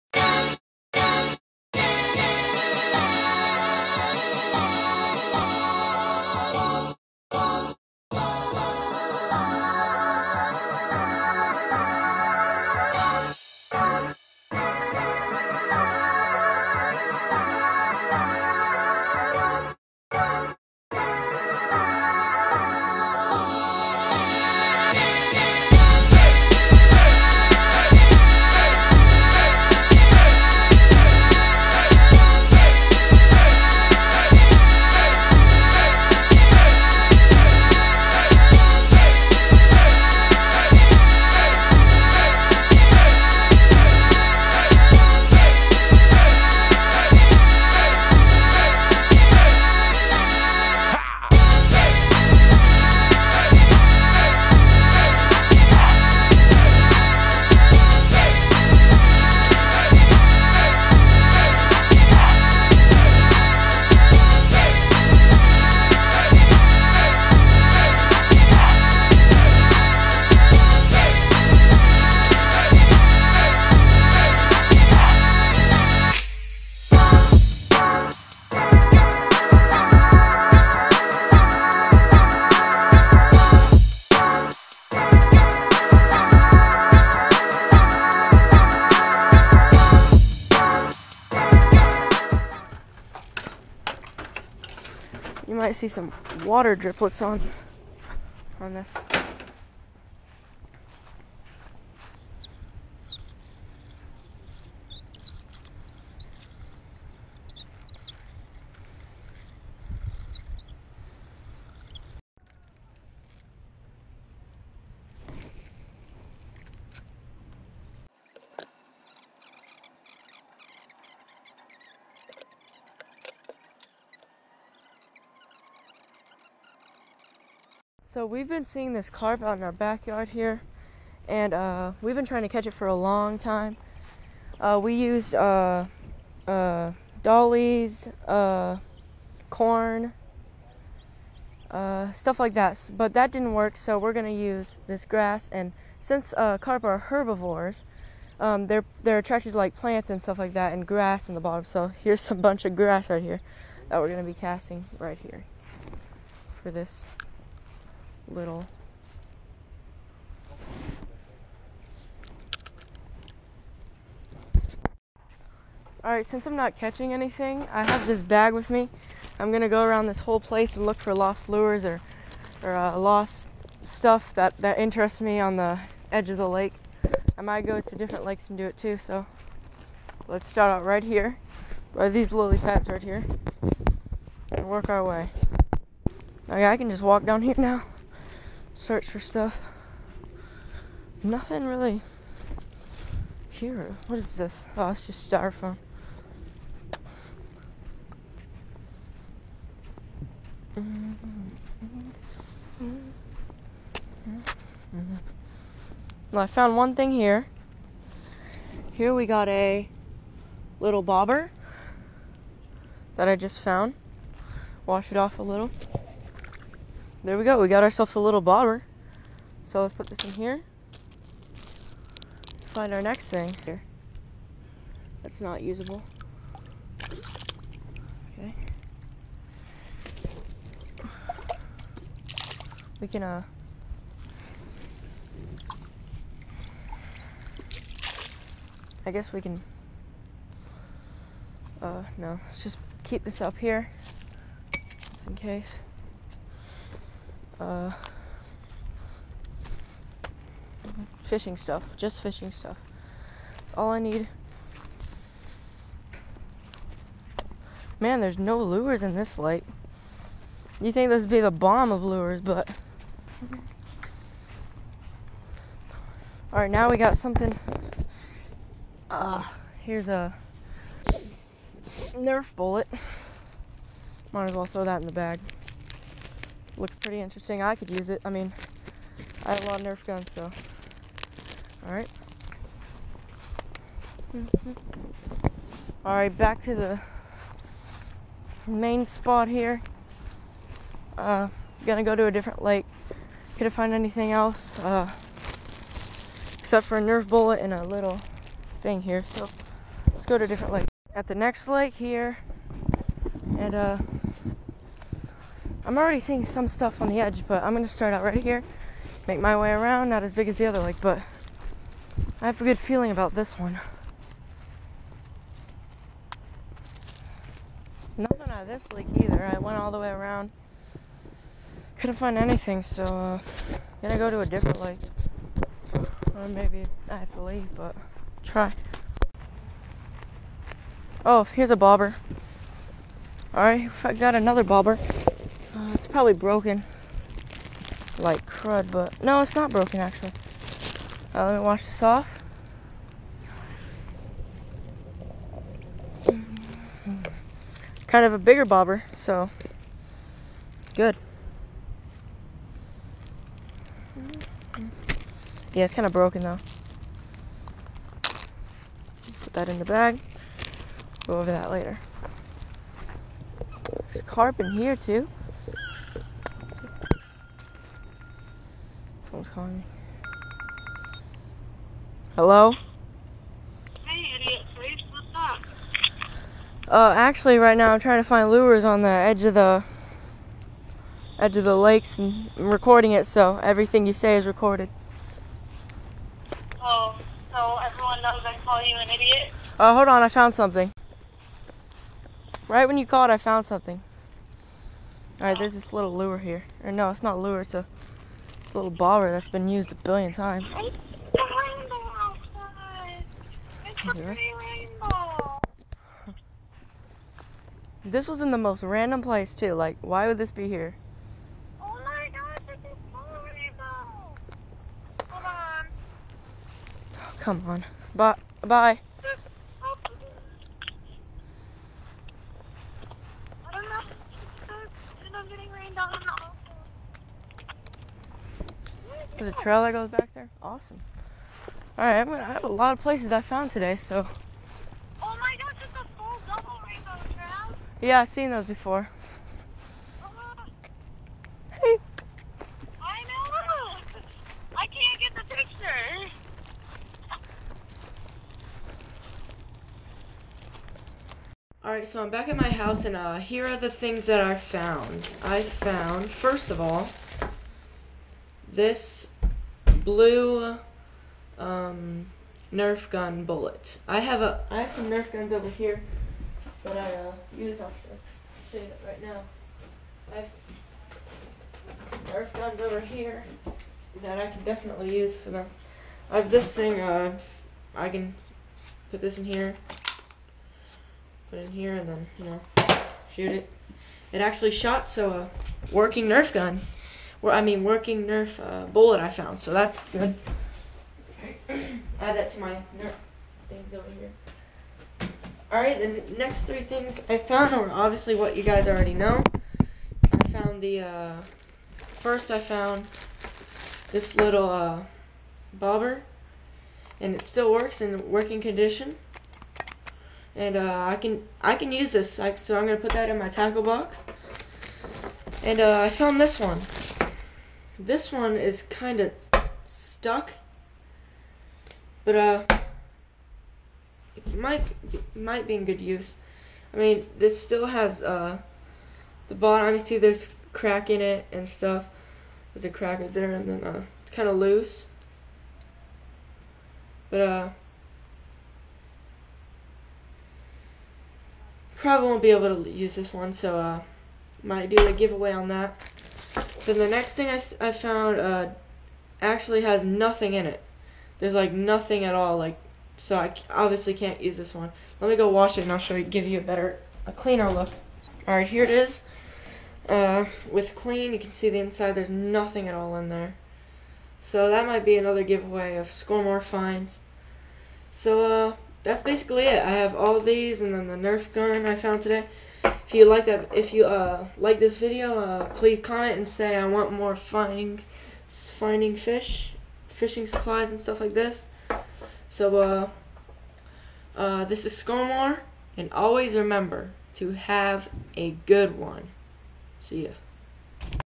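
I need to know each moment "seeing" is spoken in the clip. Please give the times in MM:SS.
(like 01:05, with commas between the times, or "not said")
02:08, 05:06.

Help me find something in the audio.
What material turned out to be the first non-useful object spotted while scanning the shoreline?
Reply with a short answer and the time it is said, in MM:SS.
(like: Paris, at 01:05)
styrofoam, at 03:15.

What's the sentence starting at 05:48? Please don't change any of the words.
Kind of a bigger bobber, so good.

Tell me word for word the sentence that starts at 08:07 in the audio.
I mean, working Nerf uh, bullet I found, so that's good.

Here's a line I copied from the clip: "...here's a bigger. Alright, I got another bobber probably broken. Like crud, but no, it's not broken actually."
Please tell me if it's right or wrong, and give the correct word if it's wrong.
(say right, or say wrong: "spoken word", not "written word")
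wrong: "bobber", not "bigger".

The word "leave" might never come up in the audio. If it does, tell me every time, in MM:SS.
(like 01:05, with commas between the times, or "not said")
05:27.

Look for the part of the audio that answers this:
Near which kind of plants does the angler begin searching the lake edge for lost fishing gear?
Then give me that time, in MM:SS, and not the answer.
03:02.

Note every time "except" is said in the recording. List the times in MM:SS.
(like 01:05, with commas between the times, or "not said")
04:56.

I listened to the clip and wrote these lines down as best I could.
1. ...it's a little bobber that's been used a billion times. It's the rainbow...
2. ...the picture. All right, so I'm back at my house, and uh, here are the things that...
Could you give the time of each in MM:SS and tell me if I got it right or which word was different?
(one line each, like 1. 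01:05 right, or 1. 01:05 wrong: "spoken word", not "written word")
1. 06:37 right
2. 07:25 right.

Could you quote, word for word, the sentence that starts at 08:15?
Alright, the next three things I found were obviously what you guys already know.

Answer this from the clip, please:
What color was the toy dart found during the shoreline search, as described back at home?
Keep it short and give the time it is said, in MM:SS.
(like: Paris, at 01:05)
blue, at 07:40.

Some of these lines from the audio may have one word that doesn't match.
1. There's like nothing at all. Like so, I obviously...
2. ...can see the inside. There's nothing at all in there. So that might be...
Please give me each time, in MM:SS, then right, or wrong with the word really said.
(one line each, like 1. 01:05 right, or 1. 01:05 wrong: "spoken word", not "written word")
1. 09:11 right
2. 09:21 right.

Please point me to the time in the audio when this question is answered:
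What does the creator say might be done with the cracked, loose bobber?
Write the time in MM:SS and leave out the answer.
09:04.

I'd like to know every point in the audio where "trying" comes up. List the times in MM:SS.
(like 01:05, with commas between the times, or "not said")
02:12, 06:17.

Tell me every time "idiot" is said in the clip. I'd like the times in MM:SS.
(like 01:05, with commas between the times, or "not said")
06:14, 06:29.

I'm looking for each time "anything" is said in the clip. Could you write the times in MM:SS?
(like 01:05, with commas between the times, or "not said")
02:47, 04:53, 05:22.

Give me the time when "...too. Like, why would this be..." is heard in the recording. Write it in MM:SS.
06:49.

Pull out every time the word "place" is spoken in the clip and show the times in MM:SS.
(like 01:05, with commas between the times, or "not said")
02:50, 06:49, 07:13.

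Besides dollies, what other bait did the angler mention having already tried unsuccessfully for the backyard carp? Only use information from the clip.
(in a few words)
corn.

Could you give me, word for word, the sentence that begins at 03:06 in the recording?
Okay, I can just walk down here now search for stuff.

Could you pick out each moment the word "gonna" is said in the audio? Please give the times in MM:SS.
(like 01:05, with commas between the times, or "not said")
02:24, 02:34, 02:49, 04:51, 05:07, 05:24, 07:12.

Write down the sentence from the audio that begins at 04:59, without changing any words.
So, let's go to a different lake.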